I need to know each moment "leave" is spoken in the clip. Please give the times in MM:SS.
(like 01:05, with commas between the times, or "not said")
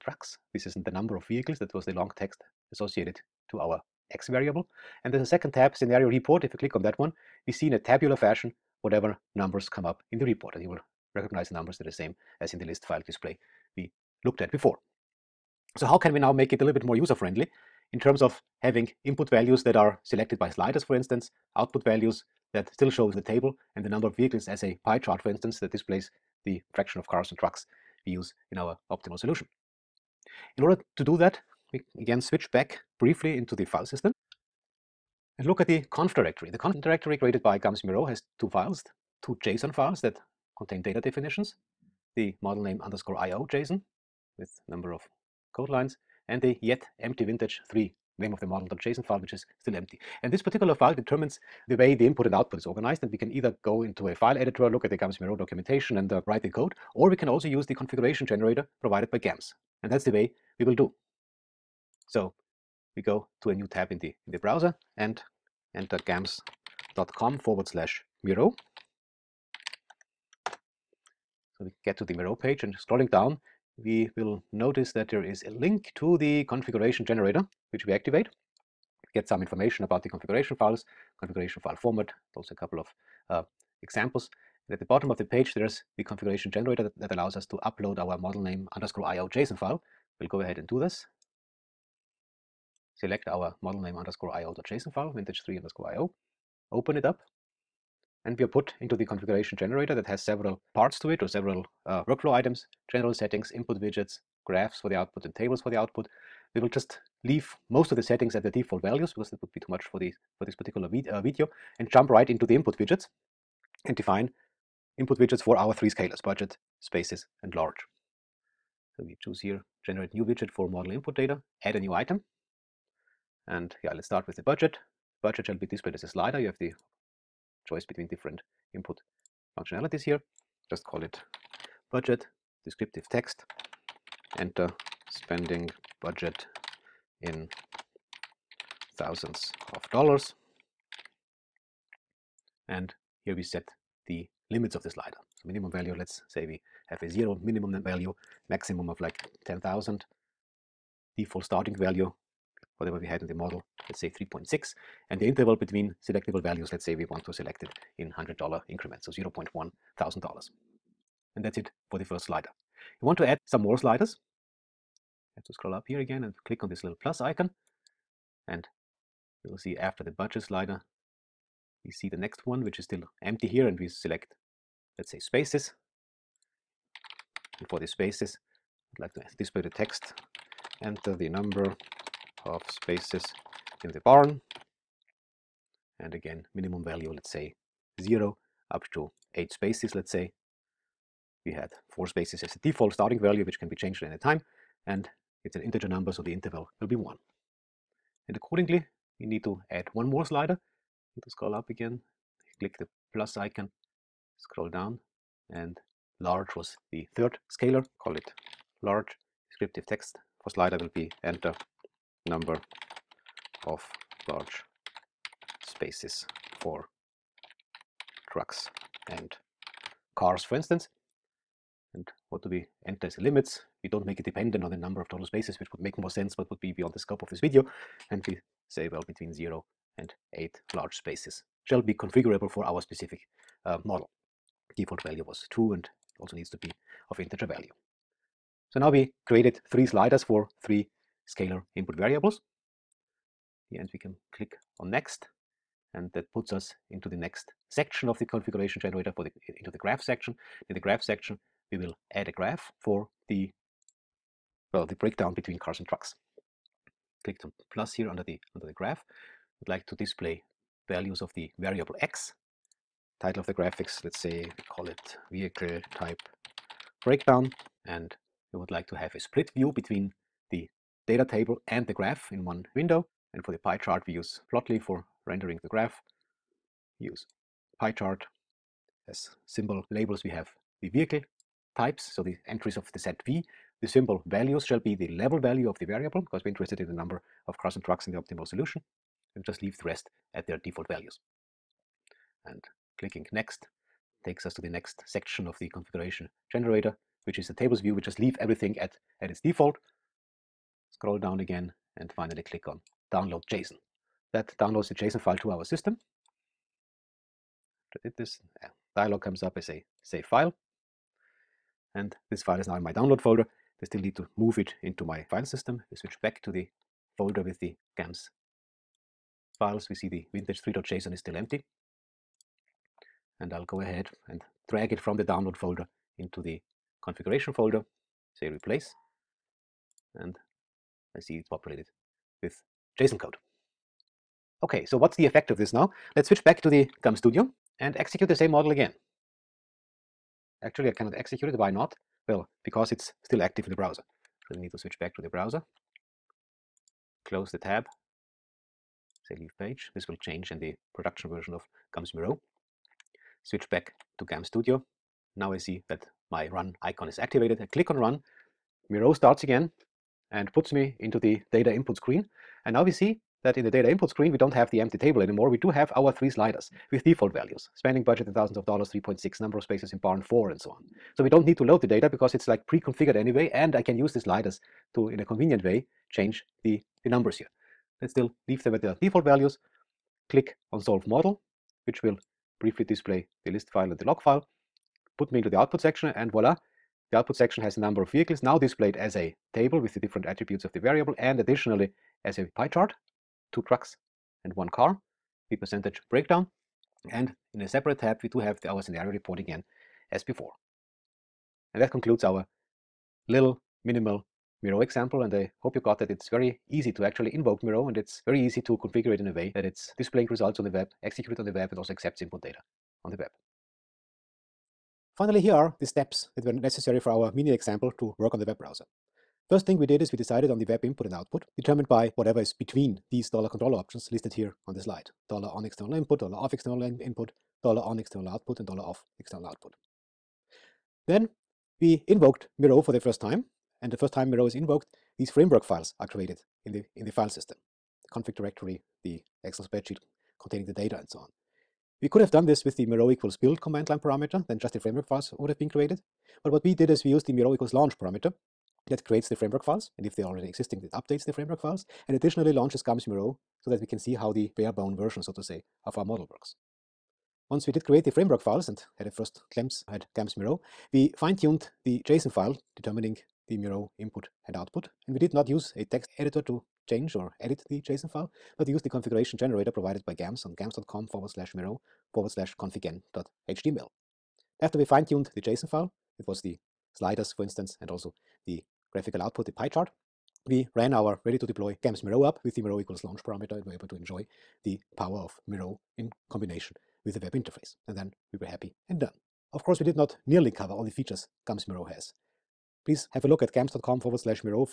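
01:47, 04:49, 04:58, 05:49, 06:18.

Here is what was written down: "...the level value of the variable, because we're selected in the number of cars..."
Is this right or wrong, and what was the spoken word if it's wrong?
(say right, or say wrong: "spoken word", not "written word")
wrong: "interested", not "selected".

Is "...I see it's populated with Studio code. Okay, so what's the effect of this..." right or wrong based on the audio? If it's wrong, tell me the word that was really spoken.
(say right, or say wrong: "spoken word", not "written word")
wrong: "JSON", not "Studio".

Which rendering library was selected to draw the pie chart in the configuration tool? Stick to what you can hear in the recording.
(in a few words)
Plotly.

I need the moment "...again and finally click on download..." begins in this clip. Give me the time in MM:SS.
05:01.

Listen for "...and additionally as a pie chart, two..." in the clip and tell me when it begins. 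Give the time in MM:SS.
06:31.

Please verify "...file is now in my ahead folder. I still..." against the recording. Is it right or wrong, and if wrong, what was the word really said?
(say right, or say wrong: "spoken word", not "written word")
wrong: "download", not "ahead".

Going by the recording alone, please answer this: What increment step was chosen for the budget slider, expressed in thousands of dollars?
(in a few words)
0.1.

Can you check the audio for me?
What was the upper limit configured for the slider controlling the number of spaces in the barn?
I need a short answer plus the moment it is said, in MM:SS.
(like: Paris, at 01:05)
8, at 03:08.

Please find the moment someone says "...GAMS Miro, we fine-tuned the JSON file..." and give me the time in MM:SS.
07:40.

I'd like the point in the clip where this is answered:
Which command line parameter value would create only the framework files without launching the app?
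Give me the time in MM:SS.
07:22.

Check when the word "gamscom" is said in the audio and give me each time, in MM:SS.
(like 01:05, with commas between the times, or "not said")
07:50, 08:13.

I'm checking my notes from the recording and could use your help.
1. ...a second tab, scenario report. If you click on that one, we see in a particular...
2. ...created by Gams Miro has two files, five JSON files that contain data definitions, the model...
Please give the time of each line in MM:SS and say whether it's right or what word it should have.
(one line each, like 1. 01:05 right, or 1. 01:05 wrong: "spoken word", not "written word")
1. 00:05 wrong: "tabular", not "particular"
2. 00:37 wrong: "two", not "five".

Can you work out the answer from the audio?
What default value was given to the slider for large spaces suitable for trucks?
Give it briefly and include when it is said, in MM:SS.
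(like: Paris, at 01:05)
2, at 03:54.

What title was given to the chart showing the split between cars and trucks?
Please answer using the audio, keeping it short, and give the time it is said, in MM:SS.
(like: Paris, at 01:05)
Vehicle type breakdown, at 04:25.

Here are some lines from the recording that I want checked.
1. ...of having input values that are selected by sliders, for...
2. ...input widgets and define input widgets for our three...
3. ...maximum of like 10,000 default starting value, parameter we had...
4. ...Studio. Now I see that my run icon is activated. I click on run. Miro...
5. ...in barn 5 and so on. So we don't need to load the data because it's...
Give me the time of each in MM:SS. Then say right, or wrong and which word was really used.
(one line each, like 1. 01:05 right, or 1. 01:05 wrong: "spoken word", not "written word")
1. 00:18 right
2. 01:52 right
3. 02:28 wrong: "whatever", not "parameter"
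4. 05:54 right
5. 06:09 wrong: "4", not "5".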